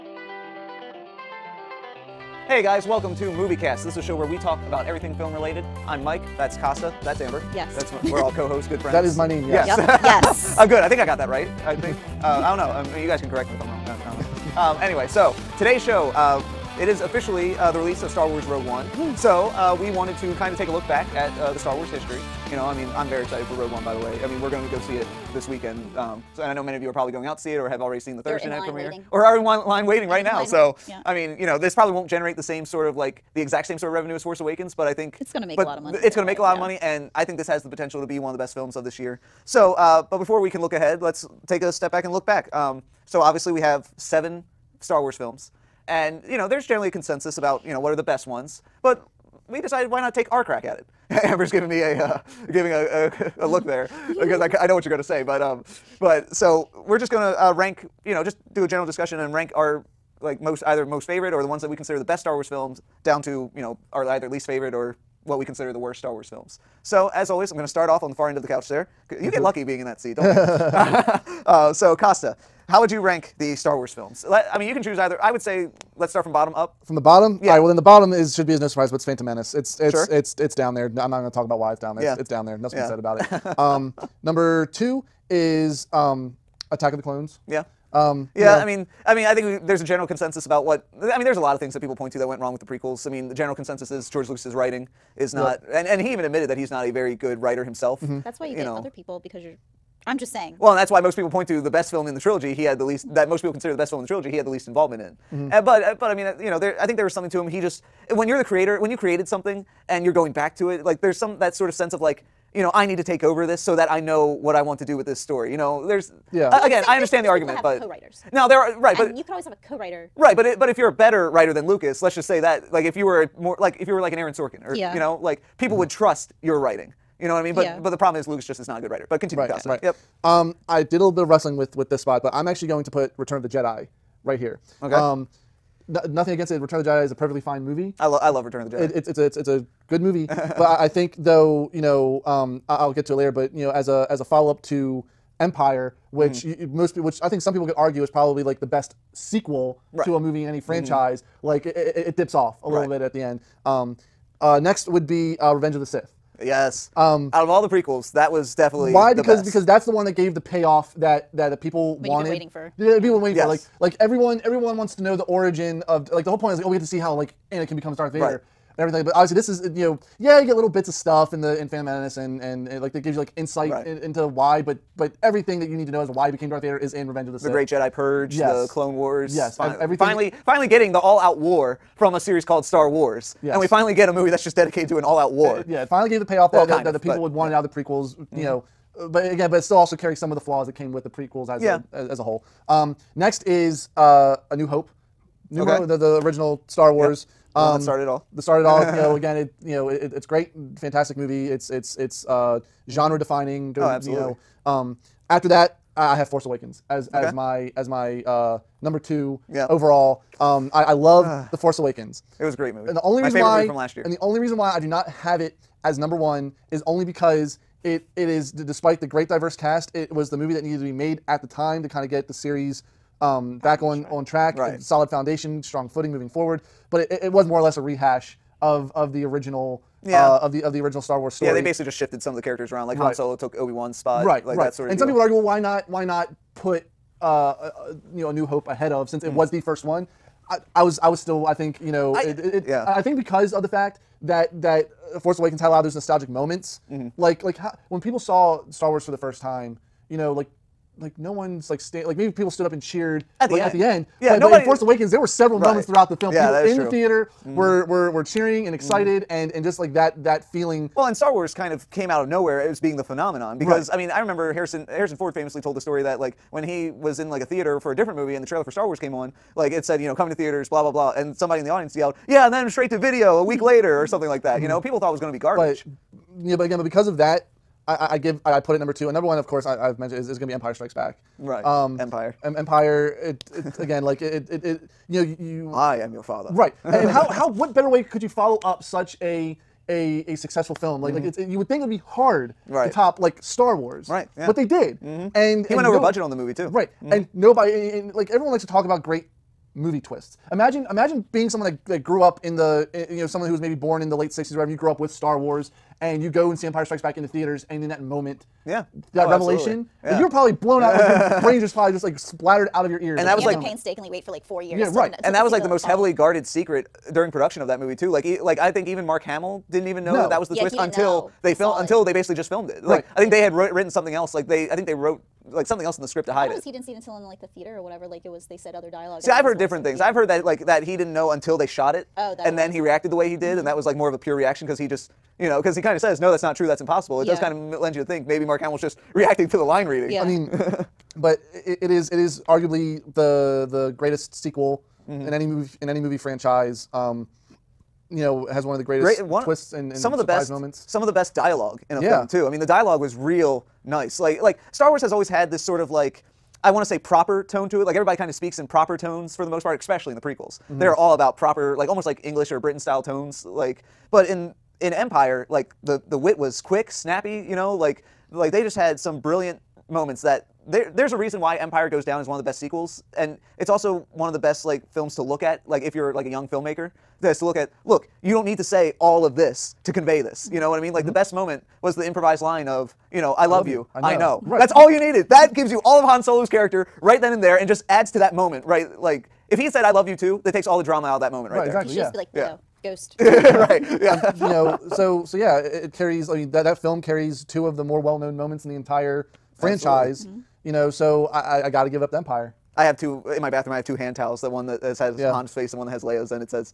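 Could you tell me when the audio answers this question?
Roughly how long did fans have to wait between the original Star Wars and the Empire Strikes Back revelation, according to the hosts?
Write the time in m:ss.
5:14.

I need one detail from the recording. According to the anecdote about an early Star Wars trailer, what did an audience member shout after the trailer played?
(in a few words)
Straight to video.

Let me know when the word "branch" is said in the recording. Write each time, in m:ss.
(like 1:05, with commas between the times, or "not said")
not said.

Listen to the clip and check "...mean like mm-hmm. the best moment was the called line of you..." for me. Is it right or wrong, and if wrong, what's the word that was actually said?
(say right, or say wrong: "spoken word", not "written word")
wrong: "improvised", not "called".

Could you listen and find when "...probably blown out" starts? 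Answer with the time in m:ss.
5:10.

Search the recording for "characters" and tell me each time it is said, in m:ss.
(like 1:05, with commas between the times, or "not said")
3:52, 6:26.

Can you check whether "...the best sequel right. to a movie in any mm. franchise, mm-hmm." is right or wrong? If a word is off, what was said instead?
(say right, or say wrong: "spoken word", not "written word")
right.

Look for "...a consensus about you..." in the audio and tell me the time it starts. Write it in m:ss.
0:46.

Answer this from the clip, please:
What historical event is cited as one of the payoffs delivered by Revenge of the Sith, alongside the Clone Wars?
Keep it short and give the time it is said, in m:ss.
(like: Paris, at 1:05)
The Great Jedi Purge, at 2:57.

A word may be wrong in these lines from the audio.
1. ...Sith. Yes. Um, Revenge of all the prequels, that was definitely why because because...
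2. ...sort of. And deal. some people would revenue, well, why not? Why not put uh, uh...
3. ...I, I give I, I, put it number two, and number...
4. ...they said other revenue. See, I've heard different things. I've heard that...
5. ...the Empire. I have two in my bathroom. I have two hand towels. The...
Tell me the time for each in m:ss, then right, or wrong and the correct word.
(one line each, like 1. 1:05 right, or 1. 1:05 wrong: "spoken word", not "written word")
1. 2:35 wrong: "Out", not "Revenge"
2. 3:54 wrong: "argue", not "revenue"
3. 4:38 right
4. 5:28 wrong: "dialogue", not "revenue"
5. 6:42 right.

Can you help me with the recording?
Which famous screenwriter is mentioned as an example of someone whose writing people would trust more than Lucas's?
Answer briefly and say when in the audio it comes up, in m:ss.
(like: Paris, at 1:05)
Aaron Sorkin, at 2:04.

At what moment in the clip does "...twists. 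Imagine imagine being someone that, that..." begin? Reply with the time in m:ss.
4:59.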